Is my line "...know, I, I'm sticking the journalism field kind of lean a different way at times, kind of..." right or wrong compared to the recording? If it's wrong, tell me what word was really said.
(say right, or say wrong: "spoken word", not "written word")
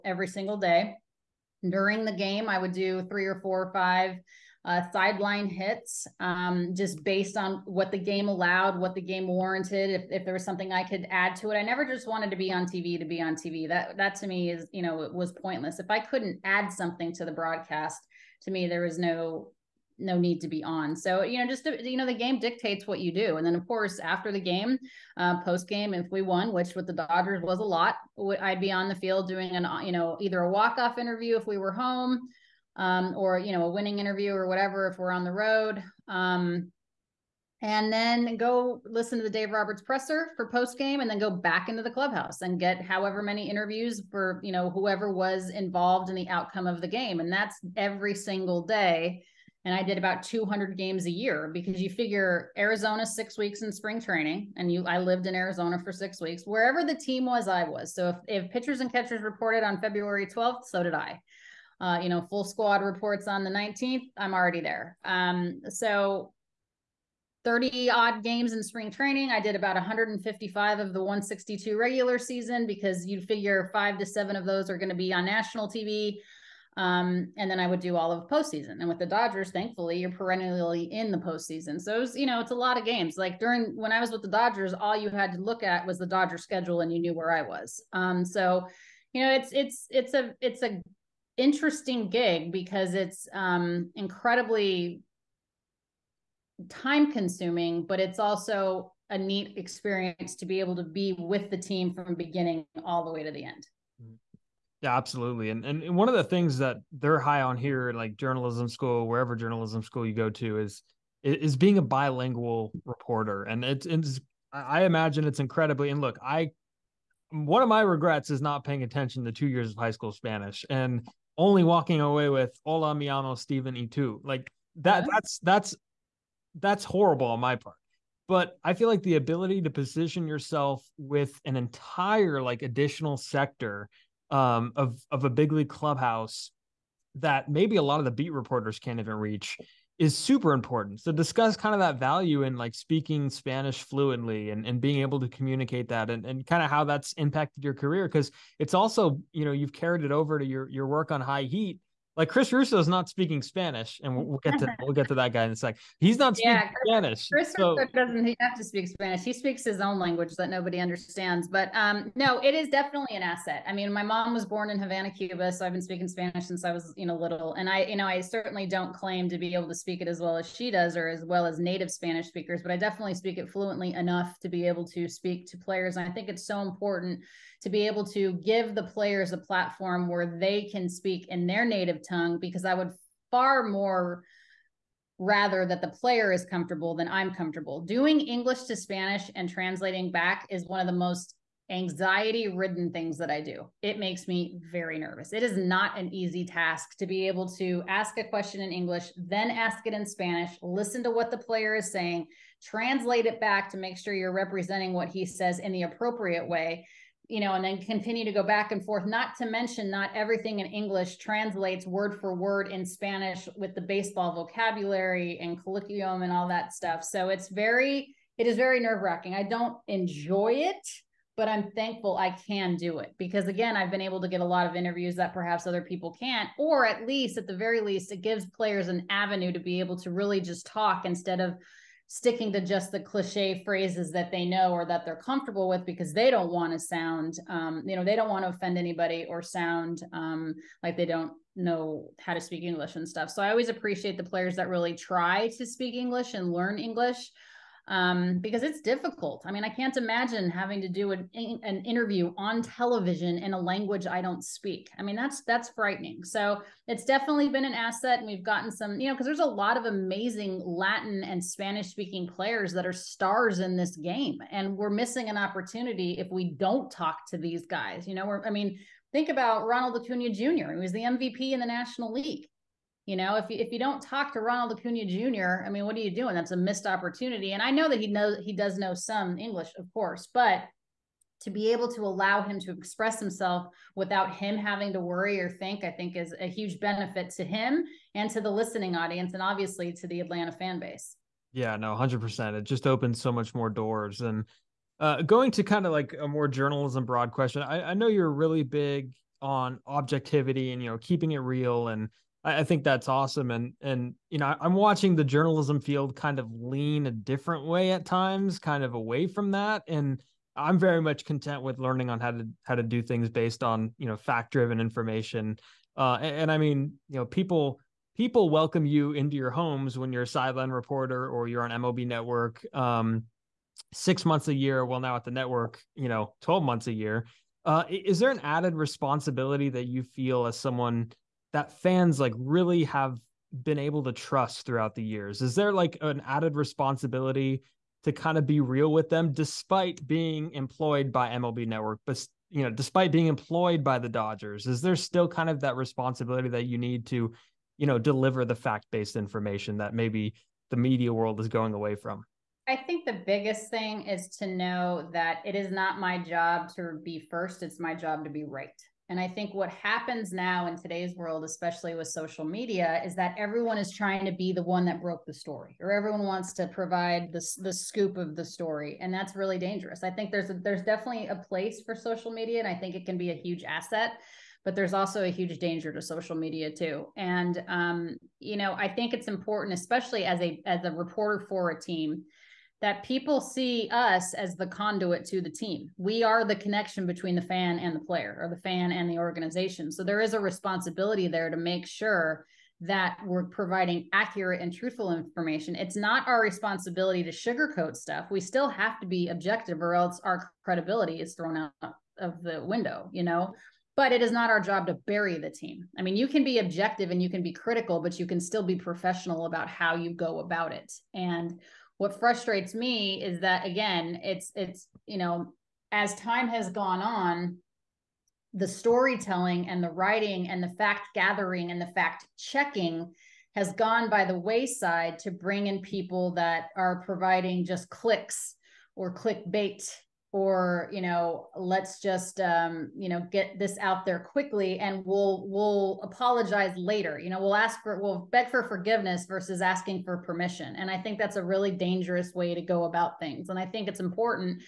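wrong: "watching", not "sticking".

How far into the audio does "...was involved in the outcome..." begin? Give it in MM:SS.
00:45.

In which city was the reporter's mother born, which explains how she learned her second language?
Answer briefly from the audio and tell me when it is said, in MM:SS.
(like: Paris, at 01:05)
Havana, Cuba, at 02:44.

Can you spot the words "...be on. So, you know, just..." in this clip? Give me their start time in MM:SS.
00:20.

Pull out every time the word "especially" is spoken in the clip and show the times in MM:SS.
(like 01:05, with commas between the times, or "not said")
06:01, 06:19.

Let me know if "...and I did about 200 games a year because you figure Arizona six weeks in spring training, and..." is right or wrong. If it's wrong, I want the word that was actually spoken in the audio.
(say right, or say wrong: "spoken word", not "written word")
right.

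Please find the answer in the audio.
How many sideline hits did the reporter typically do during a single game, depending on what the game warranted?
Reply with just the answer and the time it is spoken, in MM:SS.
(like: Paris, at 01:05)
3, 4 or 5, at 00:03.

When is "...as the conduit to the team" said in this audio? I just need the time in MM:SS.
06:24.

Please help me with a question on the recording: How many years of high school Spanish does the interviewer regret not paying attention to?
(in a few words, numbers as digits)
2.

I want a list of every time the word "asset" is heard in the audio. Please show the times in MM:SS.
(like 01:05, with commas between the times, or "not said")
02:43, 04:17, 06:13.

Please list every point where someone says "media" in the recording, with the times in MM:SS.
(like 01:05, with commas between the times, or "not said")
05:50, 06:02, 06:12, 06:16.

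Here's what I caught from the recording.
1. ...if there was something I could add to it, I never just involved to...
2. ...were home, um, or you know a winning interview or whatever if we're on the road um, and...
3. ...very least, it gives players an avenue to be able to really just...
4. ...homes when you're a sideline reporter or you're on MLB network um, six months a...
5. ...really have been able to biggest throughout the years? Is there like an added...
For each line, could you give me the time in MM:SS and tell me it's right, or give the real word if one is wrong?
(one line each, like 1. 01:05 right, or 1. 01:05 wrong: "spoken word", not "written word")
1. 00:10 wrong: "wanted", not "involved"
2. 00:31 right
3. 03:47 right
4. 05:19 right
5. 05:32 wrong: "trust", not "biggest".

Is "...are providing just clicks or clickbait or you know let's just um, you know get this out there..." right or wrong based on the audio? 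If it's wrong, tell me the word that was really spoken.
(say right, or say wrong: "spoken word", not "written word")
right.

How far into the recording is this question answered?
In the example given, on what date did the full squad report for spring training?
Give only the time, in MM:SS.
01:03.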